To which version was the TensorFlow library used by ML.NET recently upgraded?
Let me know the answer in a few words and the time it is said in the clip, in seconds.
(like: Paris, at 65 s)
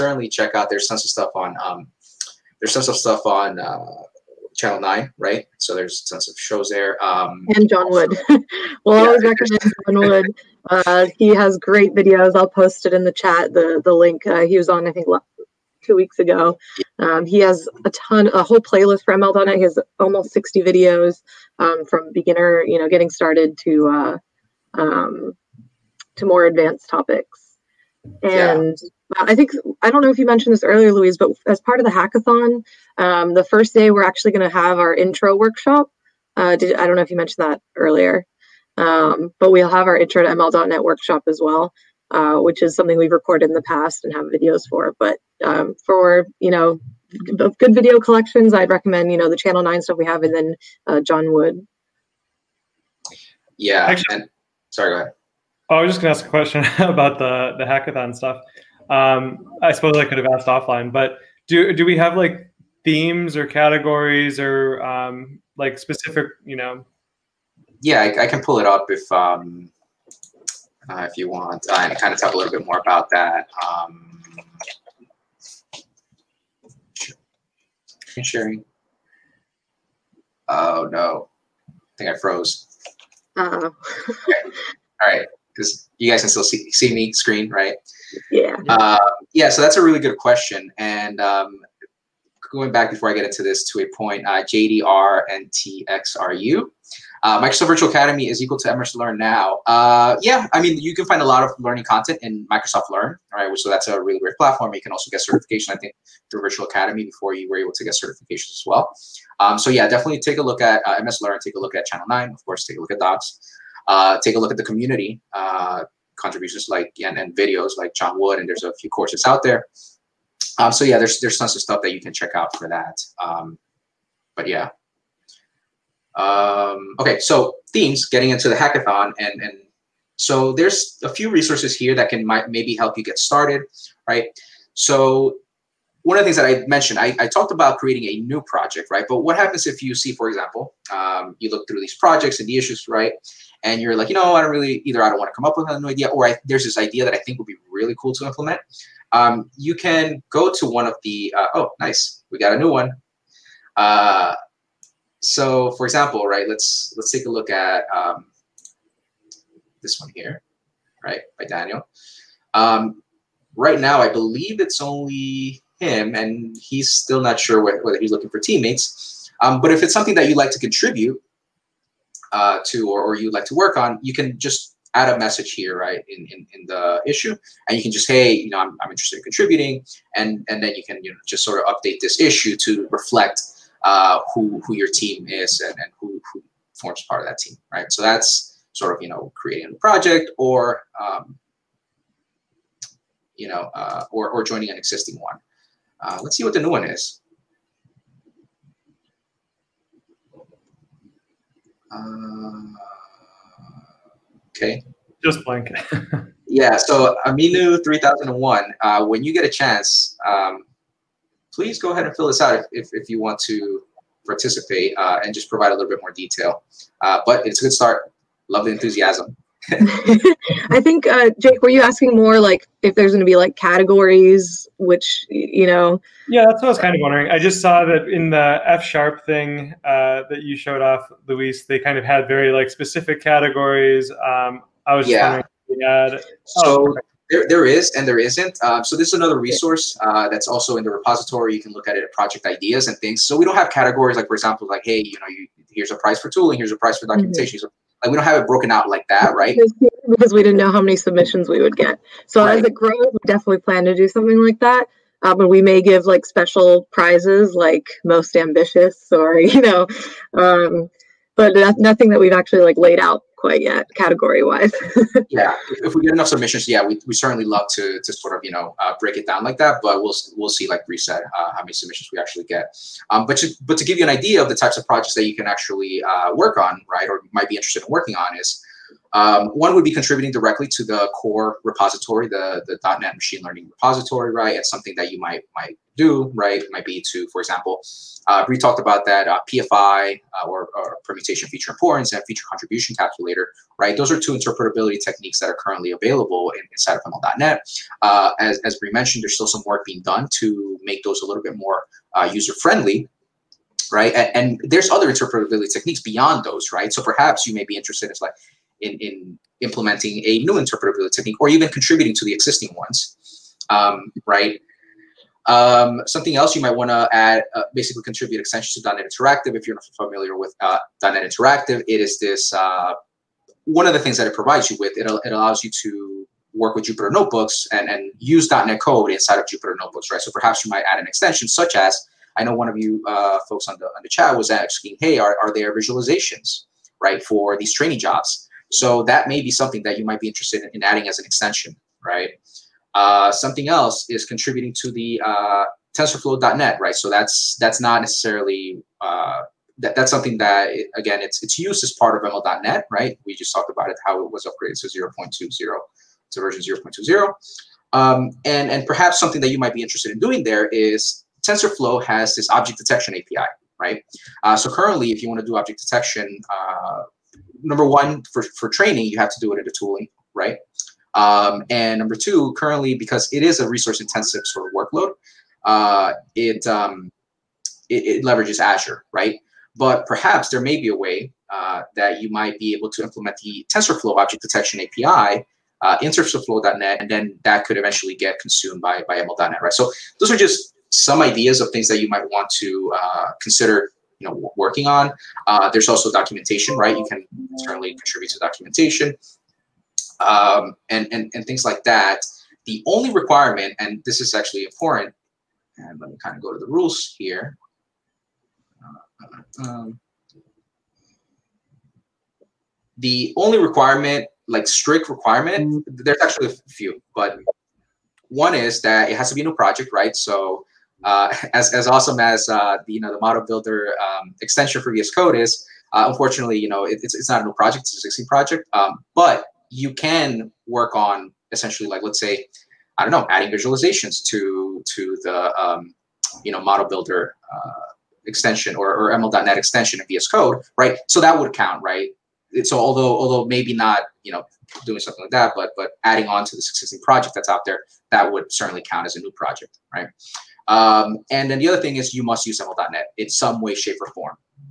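0.20, at 356 s.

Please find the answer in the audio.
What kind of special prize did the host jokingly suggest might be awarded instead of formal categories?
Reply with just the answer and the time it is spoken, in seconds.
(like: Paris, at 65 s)
Most ambitious, at 258 s.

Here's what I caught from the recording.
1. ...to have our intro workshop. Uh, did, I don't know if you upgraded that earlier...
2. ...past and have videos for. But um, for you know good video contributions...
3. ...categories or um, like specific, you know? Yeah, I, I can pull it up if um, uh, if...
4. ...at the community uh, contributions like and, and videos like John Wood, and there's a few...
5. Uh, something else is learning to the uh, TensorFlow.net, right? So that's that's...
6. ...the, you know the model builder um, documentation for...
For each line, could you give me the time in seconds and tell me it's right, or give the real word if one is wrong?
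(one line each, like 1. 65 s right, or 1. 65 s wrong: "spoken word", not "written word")
1. 34 s wrong: "mentioned", not "upgraded"
2. 43 s wrong: "collections", not "contributions"
3. 63 s right
4. 114 s right
5. 342 s wrong: "contributing", not "learning"
6. 422 s wrong: "extension", not "documentation".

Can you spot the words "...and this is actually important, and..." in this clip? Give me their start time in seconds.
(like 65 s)
403 s.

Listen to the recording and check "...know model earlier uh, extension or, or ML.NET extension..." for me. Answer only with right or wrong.
wrong.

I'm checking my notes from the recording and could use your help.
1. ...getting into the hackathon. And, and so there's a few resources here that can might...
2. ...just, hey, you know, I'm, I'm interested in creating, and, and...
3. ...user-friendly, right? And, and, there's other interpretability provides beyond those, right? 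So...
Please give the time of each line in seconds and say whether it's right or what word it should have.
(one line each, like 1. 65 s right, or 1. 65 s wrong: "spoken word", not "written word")
1. 128 s right
2. 177 s wrong: "contributing", not "creating"
3. 302 s wrong: "techniques", not "provides".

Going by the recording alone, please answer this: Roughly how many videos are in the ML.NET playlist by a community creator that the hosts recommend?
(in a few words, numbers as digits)
60.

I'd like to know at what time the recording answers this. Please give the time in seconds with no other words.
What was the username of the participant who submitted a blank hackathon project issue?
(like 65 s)
207 s.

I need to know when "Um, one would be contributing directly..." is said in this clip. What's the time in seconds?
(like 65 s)
279 s.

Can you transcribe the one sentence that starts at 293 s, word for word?
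Those are two interpretability techniques that are currently available in, inside of ML.NET.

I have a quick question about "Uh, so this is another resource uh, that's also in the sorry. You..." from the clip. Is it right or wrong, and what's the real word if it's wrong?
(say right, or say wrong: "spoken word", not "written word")
wrong: "repository", not "sorry".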